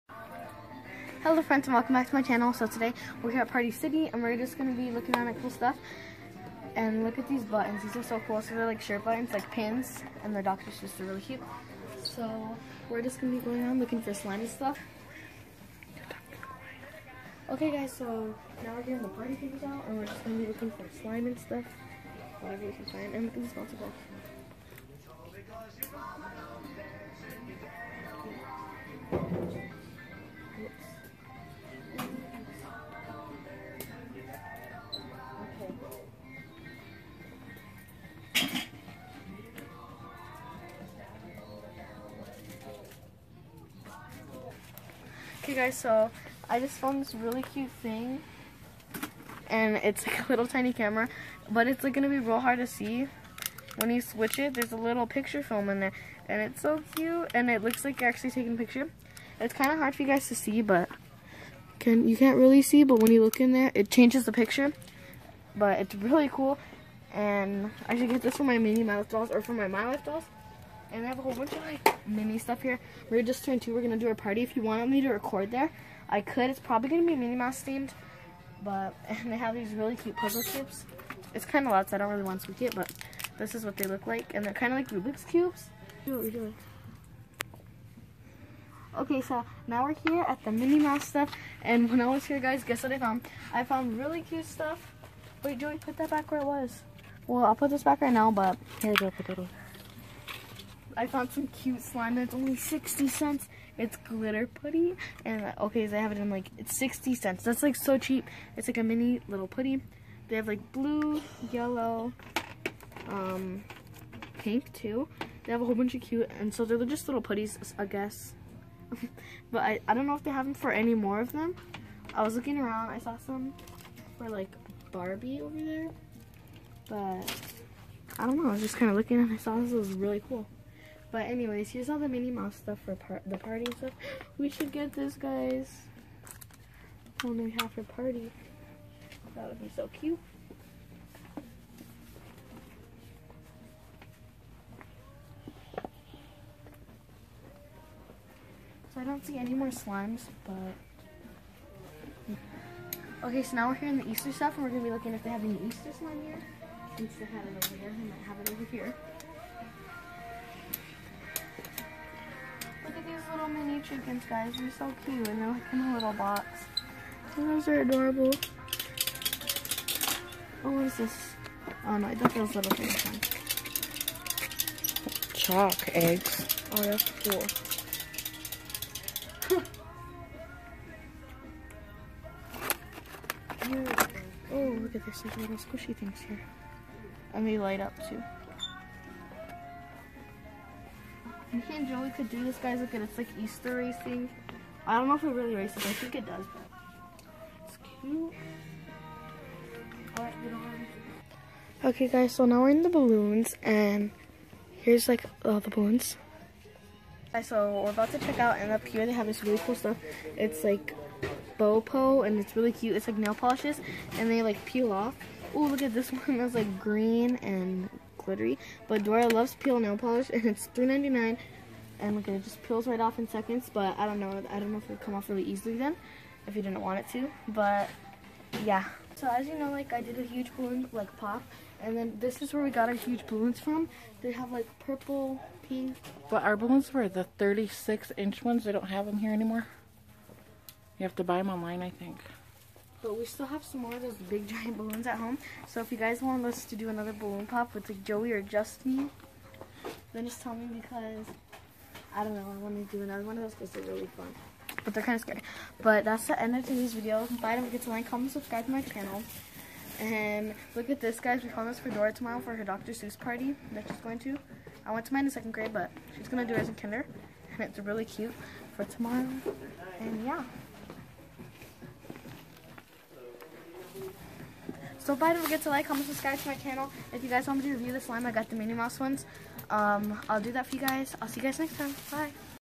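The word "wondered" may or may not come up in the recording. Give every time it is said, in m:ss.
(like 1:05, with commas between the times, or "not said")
not said.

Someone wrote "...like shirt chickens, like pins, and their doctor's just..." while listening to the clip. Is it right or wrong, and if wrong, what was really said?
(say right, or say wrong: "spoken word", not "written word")
wrong: "buttons", not "chickens".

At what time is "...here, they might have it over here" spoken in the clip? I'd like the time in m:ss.
2:37.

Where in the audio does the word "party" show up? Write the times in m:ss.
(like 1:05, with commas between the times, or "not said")
0:03, 0:19, 1:14, 2:13, 2:17, 4:23.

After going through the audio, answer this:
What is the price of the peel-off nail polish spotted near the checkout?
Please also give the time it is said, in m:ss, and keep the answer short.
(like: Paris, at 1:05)
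$3.99, at 3:40.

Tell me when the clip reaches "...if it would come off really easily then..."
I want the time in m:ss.
3:44.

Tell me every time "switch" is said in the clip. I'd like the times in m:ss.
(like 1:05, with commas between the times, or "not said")
0:54.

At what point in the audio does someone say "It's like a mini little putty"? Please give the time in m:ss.
1:48.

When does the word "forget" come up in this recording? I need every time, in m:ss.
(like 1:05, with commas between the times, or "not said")
4:17, 4:35.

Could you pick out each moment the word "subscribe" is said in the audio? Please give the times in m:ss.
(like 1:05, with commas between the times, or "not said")
4:18, 4:36.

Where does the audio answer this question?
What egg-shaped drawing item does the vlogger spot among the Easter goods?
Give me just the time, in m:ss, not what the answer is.
2:55.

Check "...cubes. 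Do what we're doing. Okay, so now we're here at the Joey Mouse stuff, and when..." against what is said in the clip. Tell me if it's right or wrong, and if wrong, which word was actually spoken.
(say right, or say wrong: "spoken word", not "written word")
wrong: "Minnie", not "Joey".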